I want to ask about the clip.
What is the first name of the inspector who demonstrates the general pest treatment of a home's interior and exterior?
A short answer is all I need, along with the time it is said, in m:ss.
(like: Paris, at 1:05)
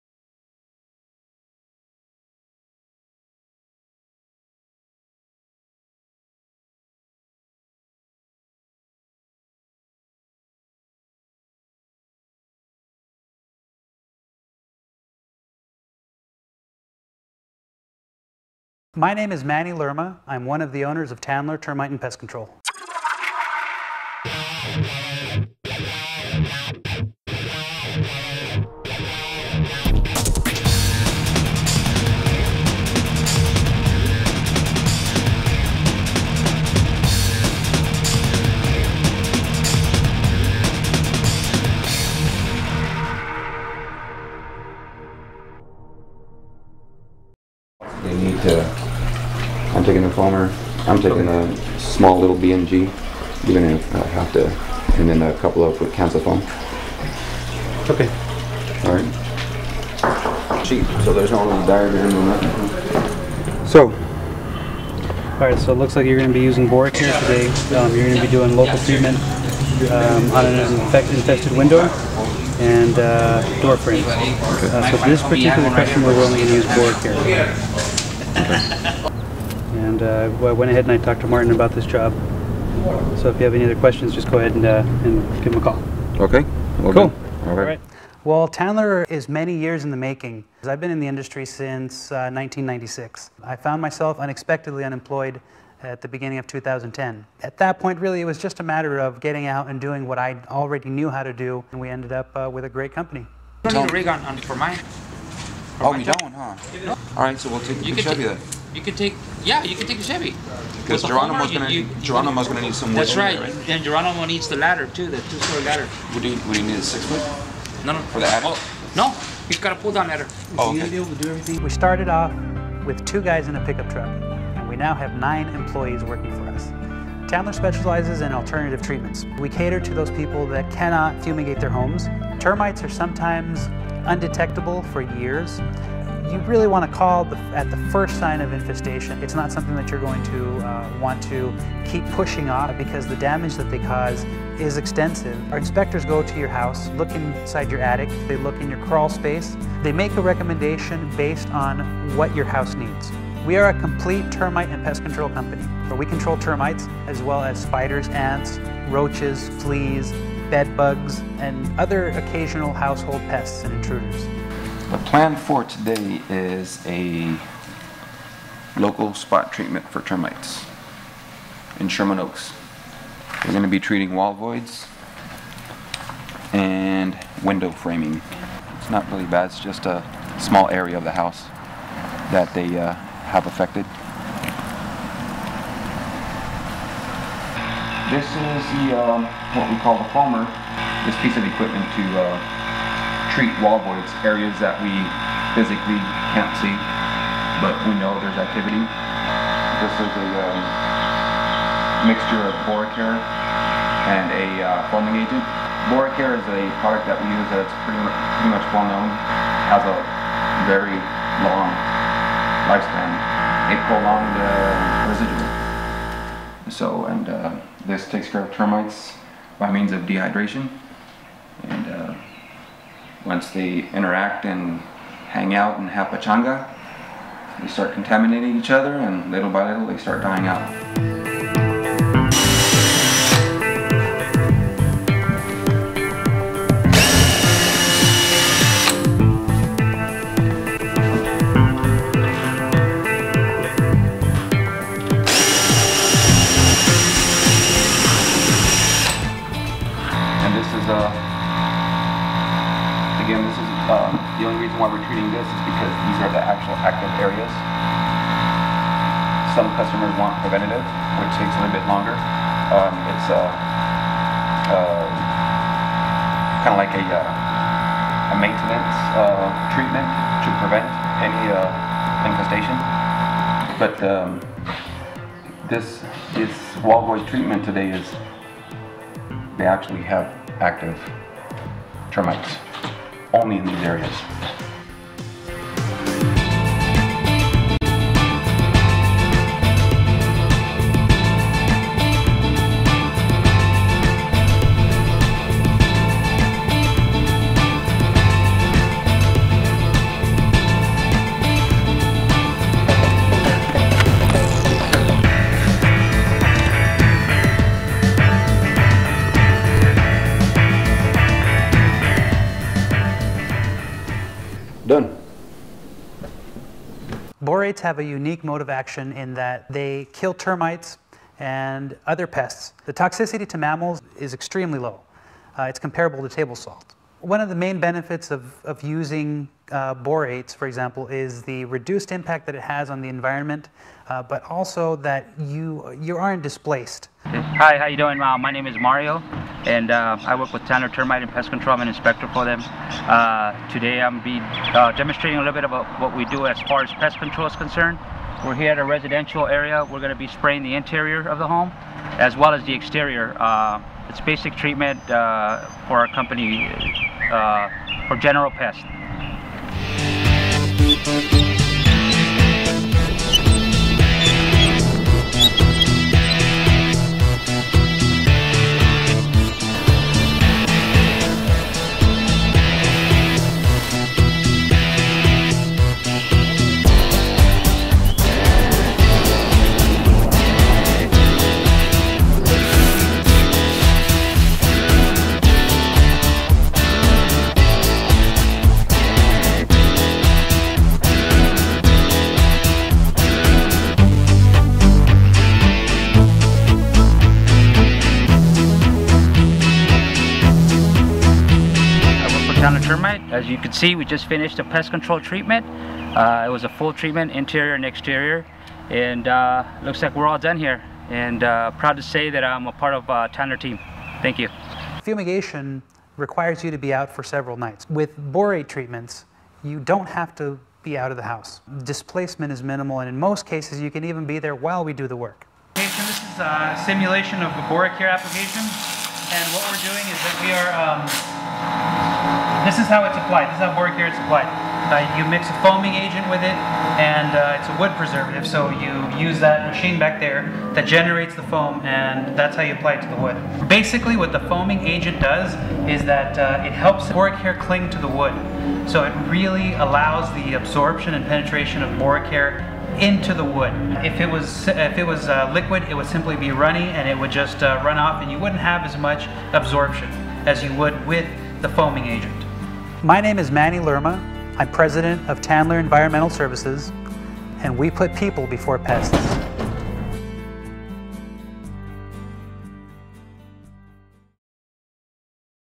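Mario, at 5:38.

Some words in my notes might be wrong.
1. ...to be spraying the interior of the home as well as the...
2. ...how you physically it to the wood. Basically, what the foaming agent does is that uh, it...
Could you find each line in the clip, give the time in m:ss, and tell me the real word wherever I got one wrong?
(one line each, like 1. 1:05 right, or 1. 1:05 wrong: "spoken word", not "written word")
1. 5:50 right
2. 7:22 wrong: "apply", not "physically".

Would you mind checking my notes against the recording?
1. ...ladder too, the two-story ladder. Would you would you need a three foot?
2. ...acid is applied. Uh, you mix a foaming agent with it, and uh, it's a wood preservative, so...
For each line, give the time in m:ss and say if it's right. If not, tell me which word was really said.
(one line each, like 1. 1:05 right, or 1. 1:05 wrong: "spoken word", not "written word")
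1. 1:54 wrong: "six", not "three"
2. 7:13 right.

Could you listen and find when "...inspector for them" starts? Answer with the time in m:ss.
5:41.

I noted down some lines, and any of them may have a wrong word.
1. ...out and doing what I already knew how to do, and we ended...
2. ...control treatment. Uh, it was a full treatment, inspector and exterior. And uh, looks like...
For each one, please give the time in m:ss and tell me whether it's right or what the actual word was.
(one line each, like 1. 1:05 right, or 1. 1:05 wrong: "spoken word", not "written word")
1. 1:39 right
2. 6:44 wrong: "interior", not "inspector".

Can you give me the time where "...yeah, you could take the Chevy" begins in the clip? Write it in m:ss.
1:49.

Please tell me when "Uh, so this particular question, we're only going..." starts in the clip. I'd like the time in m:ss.
1:14.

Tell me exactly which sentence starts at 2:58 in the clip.
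It's not really bad, it's just a small area of the house that they uh, have affected?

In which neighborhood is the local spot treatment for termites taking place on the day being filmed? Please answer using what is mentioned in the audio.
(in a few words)
Sherman Oaks.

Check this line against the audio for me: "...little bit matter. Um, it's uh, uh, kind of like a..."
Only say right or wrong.
wrong.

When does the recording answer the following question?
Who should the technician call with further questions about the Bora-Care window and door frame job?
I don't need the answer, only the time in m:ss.
1:21.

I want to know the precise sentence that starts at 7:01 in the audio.
Displacement is minimal, and in most cases, you can even be there while we do the work.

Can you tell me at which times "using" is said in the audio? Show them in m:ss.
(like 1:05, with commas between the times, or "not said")
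1:06, 5:28.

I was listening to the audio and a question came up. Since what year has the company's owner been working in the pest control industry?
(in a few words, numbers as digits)
1996.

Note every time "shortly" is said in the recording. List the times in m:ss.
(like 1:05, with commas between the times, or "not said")
not said.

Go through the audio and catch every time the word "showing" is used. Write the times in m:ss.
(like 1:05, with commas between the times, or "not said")
not said.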